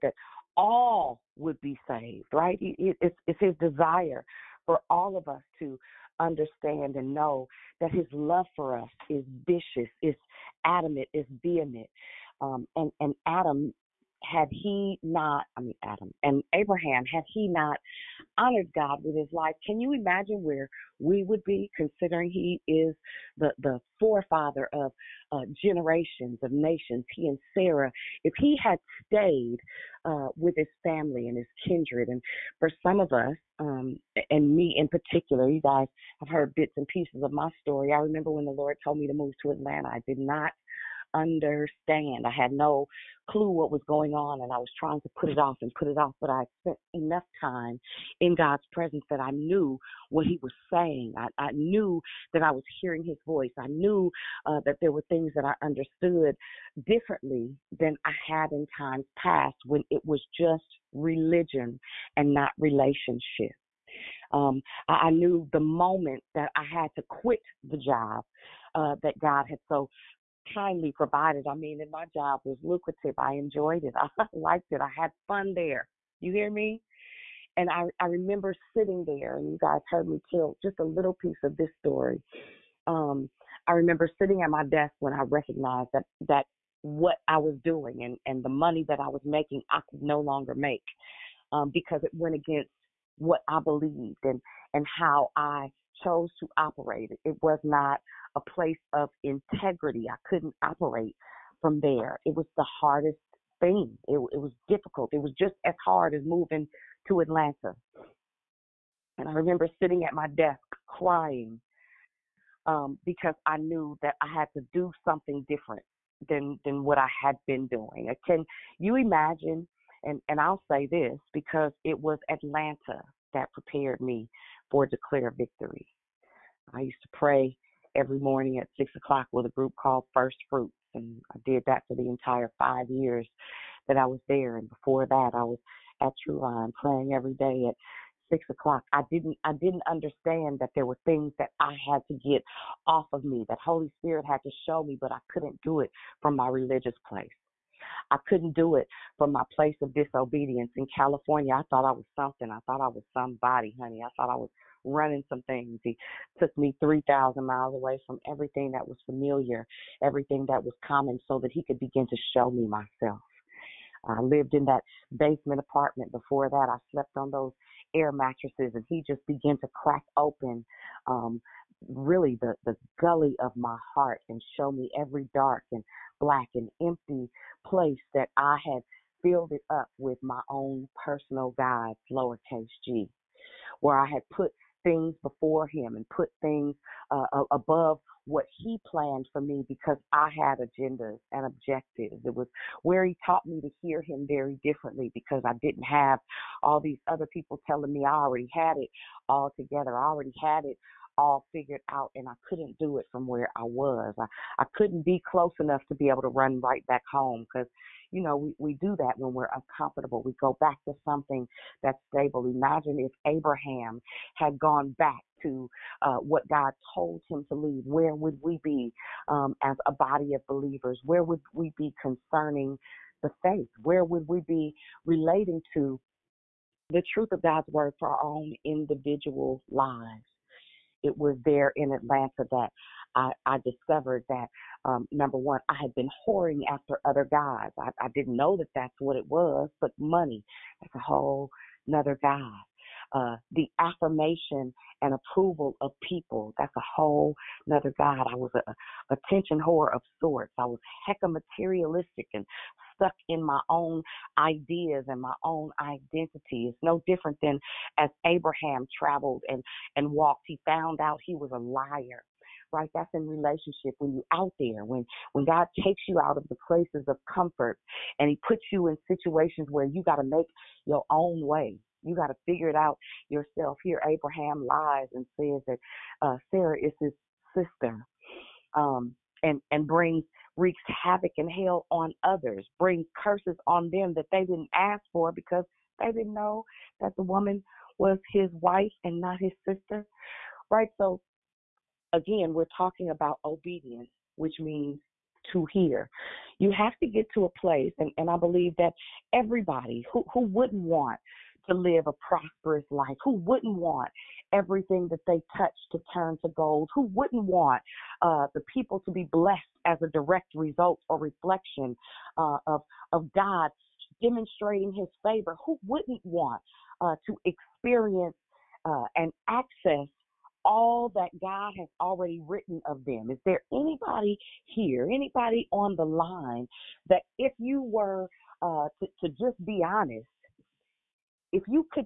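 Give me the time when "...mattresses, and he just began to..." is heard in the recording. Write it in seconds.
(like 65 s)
168 s.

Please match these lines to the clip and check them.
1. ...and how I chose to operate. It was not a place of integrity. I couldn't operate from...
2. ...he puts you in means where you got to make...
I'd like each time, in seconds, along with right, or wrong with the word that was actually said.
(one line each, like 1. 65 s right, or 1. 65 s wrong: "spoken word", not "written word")
1. 94 s right
2. 268 s wrong: "situations", not "means".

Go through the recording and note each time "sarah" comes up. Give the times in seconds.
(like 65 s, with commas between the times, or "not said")
27 s, 276 s.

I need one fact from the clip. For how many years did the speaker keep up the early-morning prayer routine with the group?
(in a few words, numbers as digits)
5.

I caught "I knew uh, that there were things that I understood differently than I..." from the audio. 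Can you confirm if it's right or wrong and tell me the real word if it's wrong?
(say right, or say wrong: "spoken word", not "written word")
right.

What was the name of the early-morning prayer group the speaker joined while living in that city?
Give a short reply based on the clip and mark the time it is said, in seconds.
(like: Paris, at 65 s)
First Fruits, at 130 s.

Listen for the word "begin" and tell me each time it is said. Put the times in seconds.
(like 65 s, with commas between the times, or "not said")
161 s.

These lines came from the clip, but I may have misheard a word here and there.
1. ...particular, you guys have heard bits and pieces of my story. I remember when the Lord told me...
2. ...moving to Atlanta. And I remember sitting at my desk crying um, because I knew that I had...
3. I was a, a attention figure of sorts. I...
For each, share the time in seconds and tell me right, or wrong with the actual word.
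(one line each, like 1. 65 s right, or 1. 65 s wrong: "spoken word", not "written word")
1. 34 s right
2. 106 s right
3. 248 s wrong: "whore", not "figure".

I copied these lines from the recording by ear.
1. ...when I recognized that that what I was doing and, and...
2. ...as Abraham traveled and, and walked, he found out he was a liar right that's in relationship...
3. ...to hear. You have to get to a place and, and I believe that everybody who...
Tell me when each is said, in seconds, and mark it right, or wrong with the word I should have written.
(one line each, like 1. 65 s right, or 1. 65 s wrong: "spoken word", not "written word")
1. 84 s right
2. 257 s right
3. 295 s right.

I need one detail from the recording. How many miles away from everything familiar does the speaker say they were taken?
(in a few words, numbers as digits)
3,000.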